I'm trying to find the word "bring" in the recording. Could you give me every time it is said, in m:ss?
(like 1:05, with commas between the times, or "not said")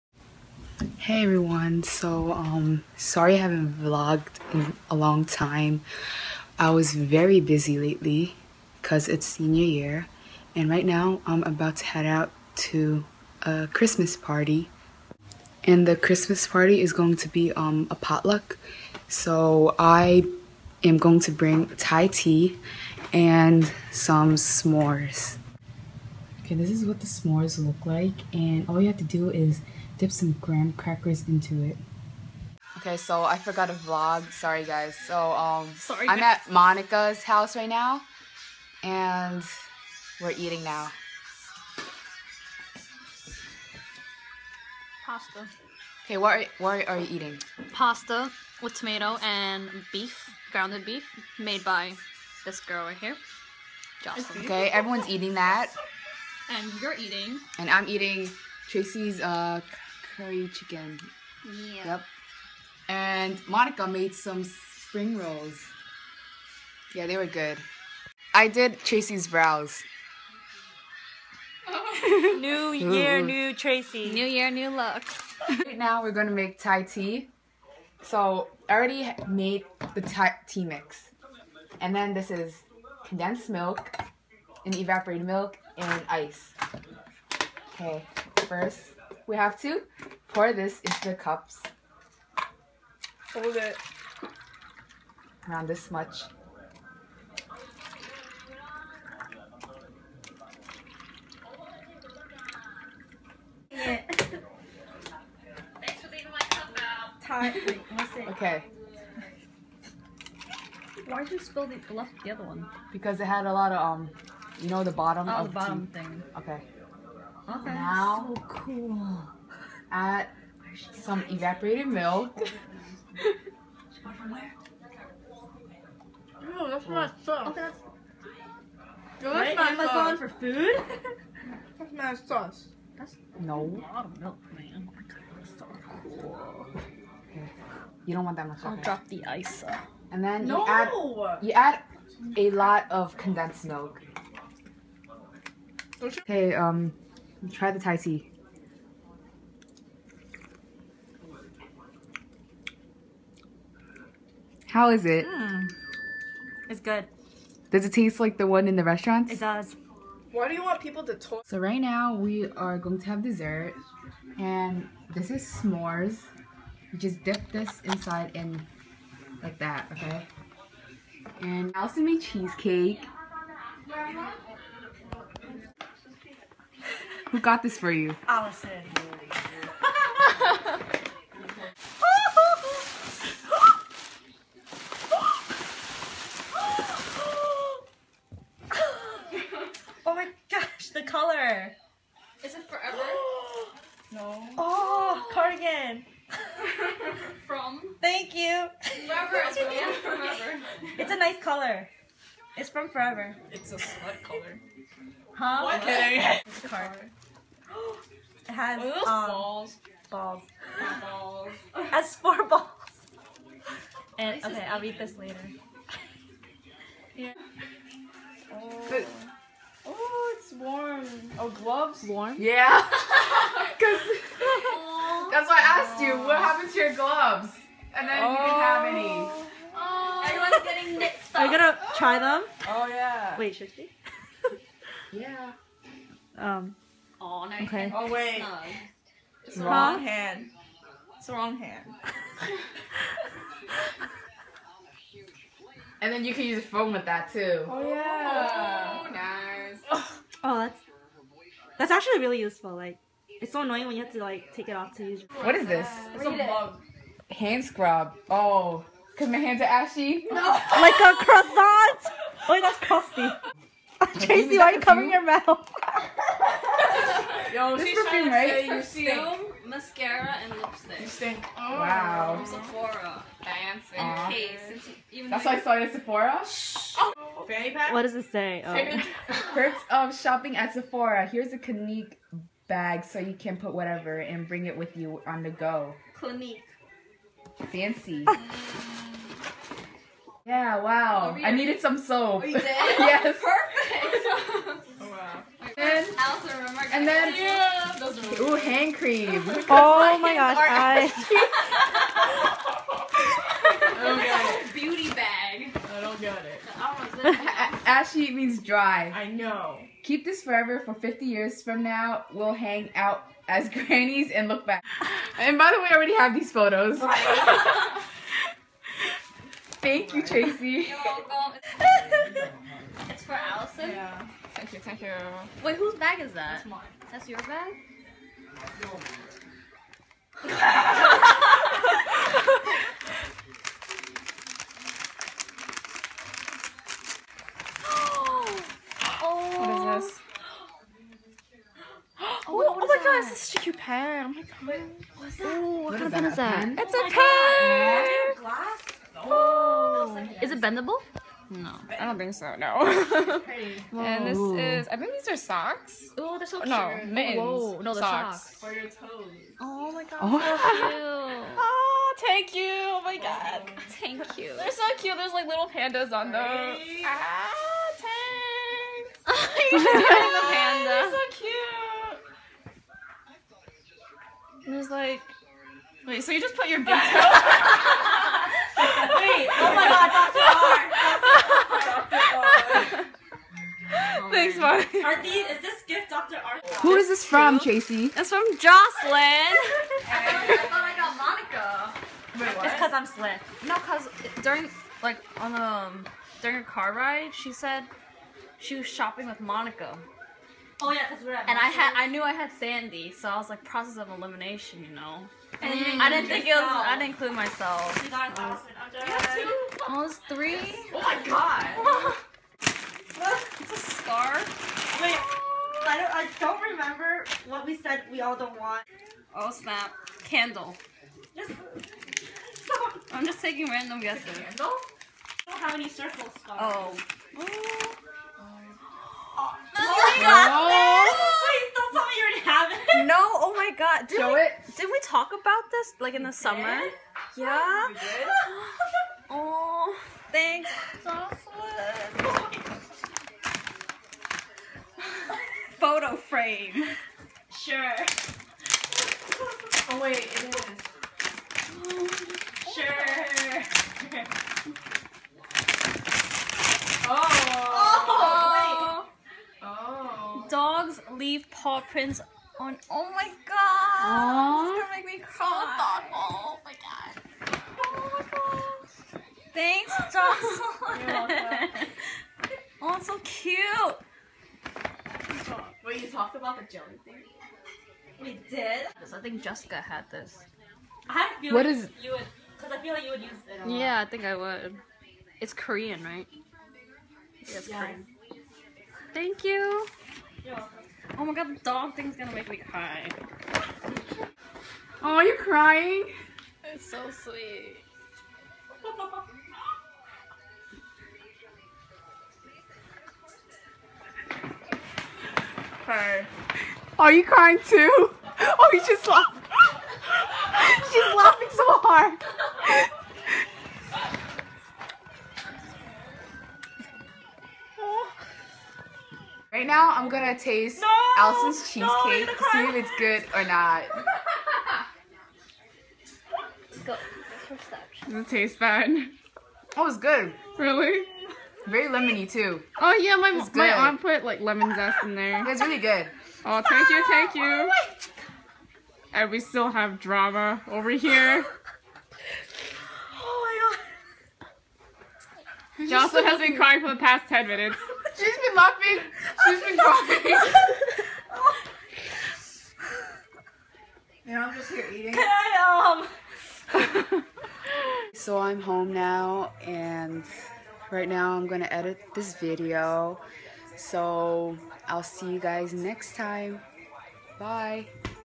0:21, 4:44.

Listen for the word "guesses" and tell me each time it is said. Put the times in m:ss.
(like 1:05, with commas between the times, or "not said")
7:04.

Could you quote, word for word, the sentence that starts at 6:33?
No, because during, like, on the, um, during a car ride, she said she was shopping with Monica.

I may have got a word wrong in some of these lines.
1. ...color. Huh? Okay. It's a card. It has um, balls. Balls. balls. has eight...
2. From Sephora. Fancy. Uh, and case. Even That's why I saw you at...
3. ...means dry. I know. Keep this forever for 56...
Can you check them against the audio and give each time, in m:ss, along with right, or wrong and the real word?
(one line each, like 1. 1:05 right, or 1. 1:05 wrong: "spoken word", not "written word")
1. 3:24 wrong: "four", not "eight"
2. 4:32 right
3. 5:08 wrong: "50", not "56".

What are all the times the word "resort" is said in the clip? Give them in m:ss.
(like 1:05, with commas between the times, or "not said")
not said.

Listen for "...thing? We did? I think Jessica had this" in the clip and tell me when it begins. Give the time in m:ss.
7:57.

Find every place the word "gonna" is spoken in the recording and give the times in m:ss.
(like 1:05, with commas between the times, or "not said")
1:16, 3:51, 7:44, 8:12, 8:40.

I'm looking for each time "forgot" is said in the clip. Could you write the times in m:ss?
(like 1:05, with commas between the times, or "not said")
0:33.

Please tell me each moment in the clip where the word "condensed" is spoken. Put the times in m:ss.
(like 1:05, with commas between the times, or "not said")
1:23, 2:23.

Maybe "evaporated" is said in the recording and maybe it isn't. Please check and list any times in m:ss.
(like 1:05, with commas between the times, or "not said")
1:24, 2:01.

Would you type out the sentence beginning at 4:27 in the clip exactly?
No, this she's perfume, trying right?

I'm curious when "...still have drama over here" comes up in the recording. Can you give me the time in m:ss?
8:59.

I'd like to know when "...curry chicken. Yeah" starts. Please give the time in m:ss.
1:00.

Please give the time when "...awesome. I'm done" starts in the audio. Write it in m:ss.
6:48.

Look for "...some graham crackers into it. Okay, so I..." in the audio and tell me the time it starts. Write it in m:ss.
0:30.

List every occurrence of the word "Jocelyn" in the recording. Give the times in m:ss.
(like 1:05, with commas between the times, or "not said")
0:54, 6:28, 7:21.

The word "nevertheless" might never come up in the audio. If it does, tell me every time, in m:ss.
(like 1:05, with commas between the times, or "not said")
not said.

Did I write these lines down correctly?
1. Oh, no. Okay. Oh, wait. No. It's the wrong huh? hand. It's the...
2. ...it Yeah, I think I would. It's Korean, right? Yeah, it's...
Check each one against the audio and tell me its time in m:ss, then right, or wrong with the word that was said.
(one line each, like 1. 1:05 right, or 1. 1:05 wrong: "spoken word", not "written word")
1. 3:57 right
2. 8:03 right.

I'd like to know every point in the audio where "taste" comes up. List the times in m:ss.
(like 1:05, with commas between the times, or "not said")
2:37, 8:40, 8:48.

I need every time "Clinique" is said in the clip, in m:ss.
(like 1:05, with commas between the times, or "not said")
4:41, 4:46.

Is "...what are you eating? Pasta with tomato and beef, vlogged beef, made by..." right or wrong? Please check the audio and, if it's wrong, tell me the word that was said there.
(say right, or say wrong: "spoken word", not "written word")
wrong: "grounded", not "vlogged".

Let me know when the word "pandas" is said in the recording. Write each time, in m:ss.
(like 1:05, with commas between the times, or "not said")
6:05, 6:10.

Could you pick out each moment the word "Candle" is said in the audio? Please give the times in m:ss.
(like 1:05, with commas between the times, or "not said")
7:00, 7:04.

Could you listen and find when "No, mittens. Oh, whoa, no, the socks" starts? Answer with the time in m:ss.
5:56.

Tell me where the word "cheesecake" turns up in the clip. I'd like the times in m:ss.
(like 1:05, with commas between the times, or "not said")
2:52, 8:41.